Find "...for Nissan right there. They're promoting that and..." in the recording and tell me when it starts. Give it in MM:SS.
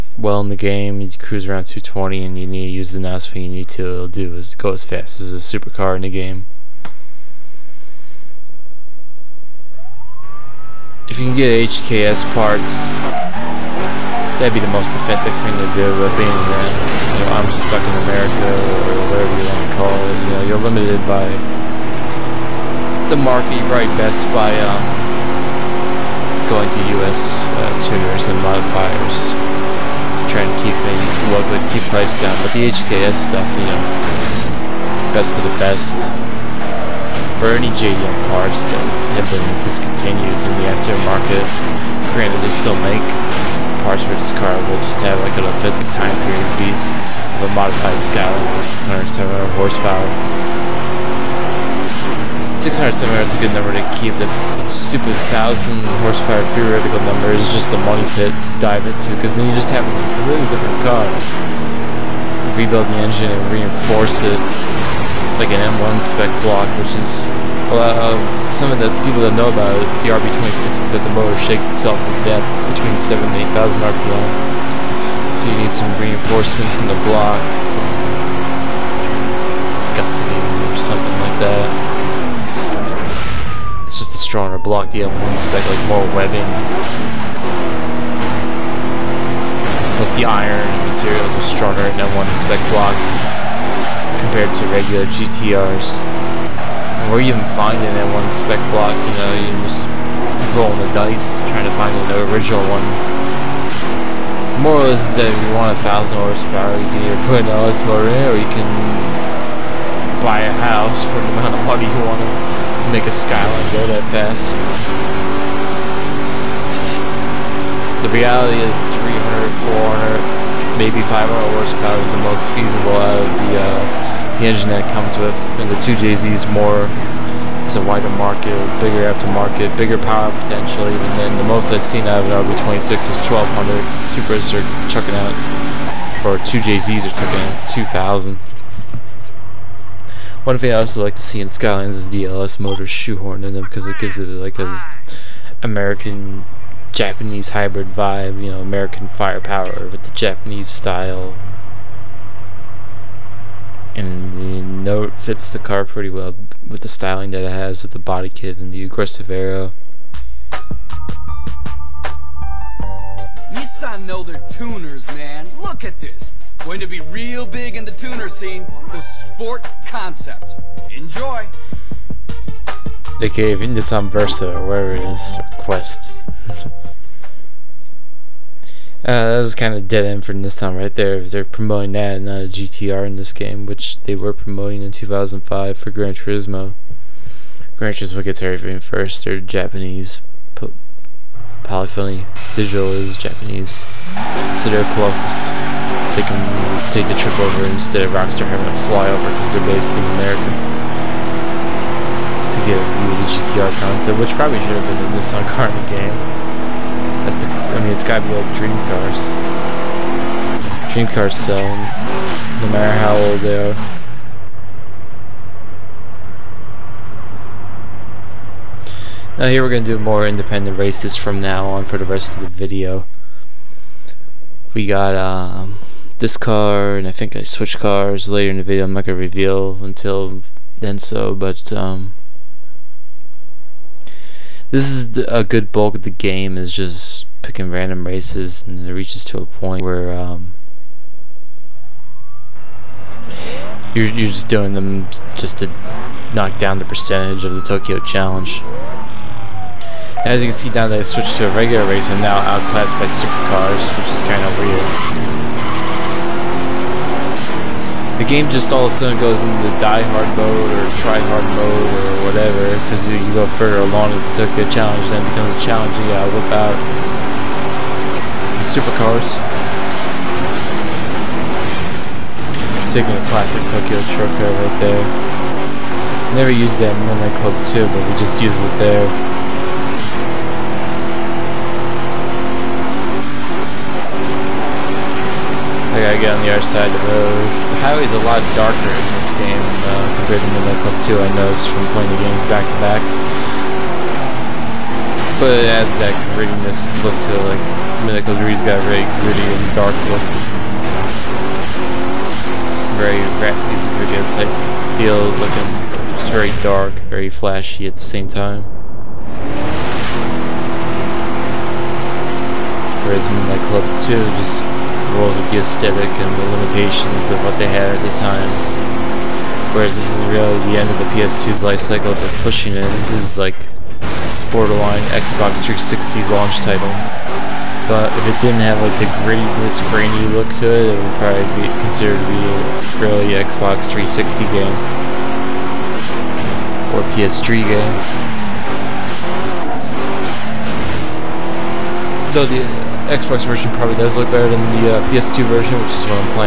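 03:00.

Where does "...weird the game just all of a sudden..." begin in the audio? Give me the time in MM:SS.
04:14.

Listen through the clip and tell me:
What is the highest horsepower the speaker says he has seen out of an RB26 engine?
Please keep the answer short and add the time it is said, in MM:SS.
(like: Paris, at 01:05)
1200, at 02:13.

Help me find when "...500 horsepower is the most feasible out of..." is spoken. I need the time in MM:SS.
02:01.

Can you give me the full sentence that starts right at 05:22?
This is like borderline Xbox 360 launch title.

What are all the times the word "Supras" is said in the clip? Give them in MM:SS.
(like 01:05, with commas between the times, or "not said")
02:14.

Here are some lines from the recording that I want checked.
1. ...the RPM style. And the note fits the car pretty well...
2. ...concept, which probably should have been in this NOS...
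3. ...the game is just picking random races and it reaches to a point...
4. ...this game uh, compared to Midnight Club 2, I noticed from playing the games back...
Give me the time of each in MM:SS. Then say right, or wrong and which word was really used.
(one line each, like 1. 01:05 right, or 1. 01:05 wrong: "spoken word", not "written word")
1. 02:30 wrong: "Japanese", not "RPM"
2. 03:23 wrong: "Sun", not "NOS"
3. 03:56 right
4. 04:49 right.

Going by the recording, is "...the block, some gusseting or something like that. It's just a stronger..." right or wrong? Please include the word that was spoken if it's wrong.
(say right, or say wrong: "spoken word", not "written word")
right.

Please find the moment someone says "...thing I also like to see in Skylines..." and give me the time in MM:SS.
02:20.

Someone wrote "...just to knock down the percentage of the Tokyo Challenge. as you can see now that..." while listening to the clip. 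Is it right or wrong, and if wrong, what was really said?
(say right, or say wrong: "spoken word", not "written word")
right.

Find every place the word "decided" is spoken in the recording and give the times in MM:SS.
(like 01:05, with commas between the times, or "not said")
not said.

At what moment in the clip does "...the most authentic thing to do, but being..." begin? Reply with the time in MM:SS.
00:14.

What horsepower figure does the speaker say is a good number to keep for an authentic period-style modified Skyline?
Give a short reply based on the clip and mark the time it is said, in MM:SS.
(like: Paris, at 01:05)
607, at 00:48.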